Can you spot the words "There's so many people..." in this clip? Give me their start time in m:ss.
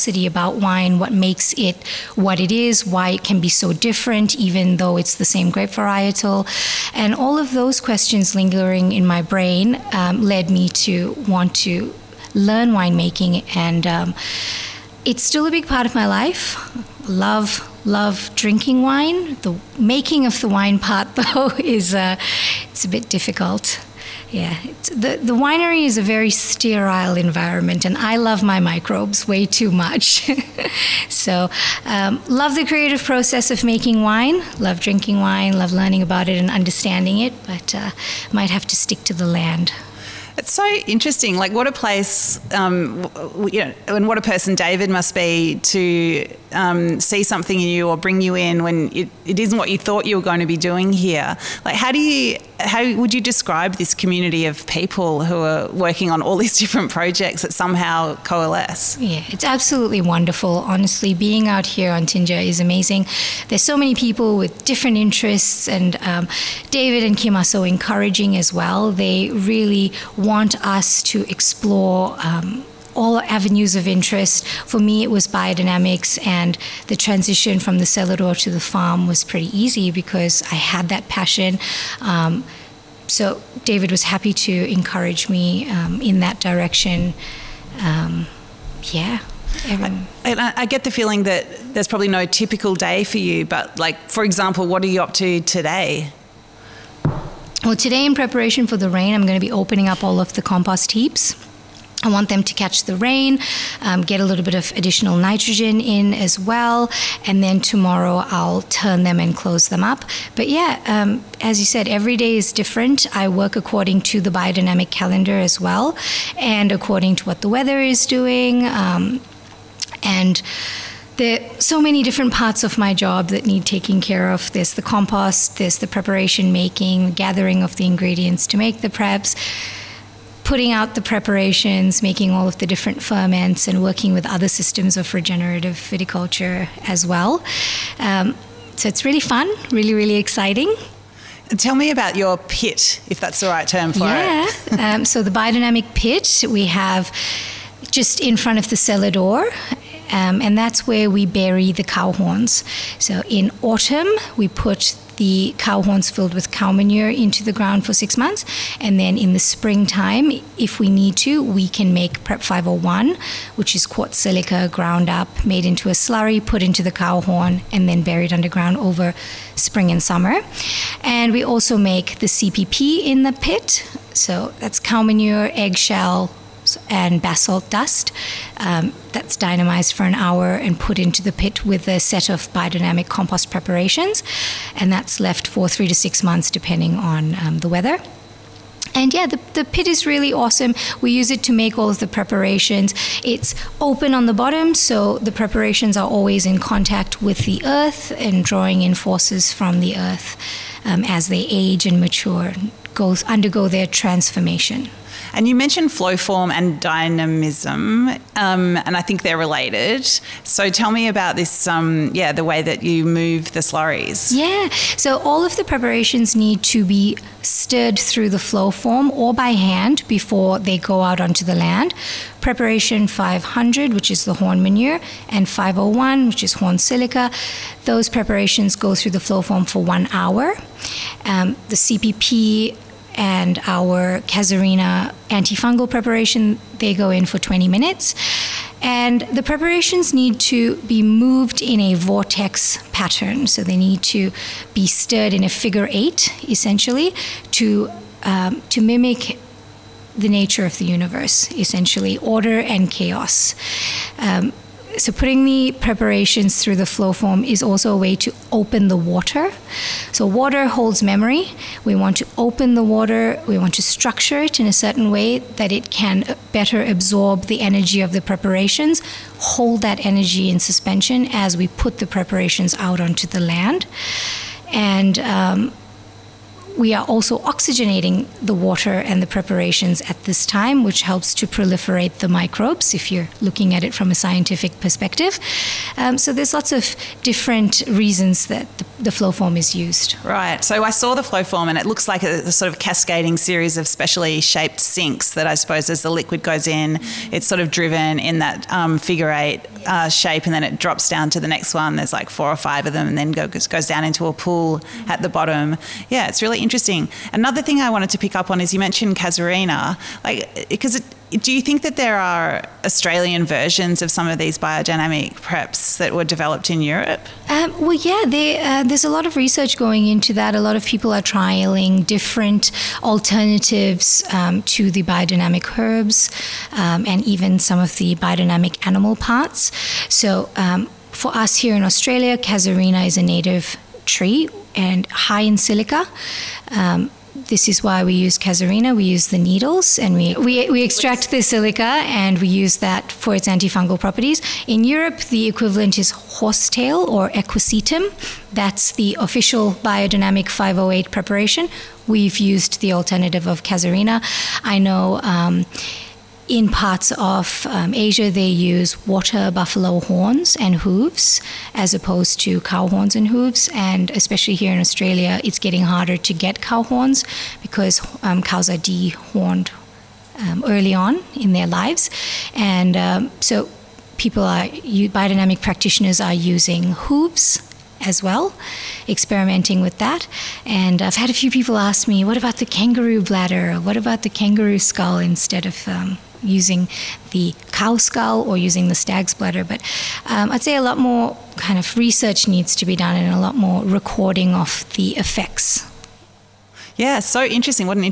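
1:03.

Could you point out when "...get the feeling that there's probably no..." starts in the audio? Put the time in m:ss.
1:30.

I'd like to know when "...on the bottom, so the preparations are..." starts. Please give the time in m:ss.
3:14.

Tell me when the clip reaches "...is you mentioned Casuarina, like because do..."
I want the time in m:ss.
5:08.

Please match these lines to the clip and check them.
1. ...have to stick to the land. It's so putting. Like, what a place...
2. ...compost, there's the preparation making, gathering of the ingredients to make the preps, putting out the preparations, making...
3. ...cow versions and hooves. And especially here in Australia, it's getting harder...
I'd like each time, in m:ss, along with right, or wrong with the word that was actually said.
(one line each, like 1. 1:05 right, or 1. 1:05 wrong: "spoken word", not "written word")
1. 0:38 wrong: "interesting", not "putting"
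2. 2:04 right
3. 6:02 wrong: "horns", not "versions".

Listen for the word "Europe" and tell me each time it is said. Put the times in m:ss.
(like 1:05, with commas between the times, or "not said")
5:16, 5:44.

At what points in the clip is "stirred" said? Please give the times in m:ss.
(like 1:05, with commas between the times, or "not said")
3:37, 4:04.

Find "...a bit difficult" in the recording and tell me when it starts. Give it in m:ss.
0:22.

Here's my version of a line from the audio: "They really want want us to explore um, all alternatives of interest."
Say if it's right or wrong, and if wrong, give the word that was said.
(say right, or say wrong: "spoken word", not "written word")
wrong: "avenues", not "alternatives".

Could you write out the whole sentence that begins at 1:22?
Um, so David was happy to encourage me um, in that direction.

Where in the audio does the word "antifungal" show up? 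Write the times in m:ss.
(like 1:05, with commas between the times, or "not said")
3:55, 5:43.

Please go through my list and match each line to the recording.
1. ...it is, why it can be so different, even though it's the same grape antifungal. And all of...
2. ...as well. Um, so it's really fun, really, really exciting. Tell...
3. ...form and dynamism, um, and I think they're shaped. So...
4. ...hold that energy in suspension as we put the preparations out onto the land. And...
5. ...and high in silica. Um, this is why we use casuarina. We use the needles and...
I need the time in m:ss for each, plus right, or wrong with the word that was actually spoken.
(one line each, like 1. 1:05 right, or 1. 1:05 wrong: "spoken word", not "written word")
1. 0:02 wrong: "varietal", not "antifungal"
2. 2:16 right
3. 3:26 wrong: "related", not "shaped"
4. 4:29 right
5. 5:34 right.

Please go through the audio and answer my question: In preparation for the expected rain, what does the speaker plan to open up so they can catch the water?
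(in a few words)
compost heaps.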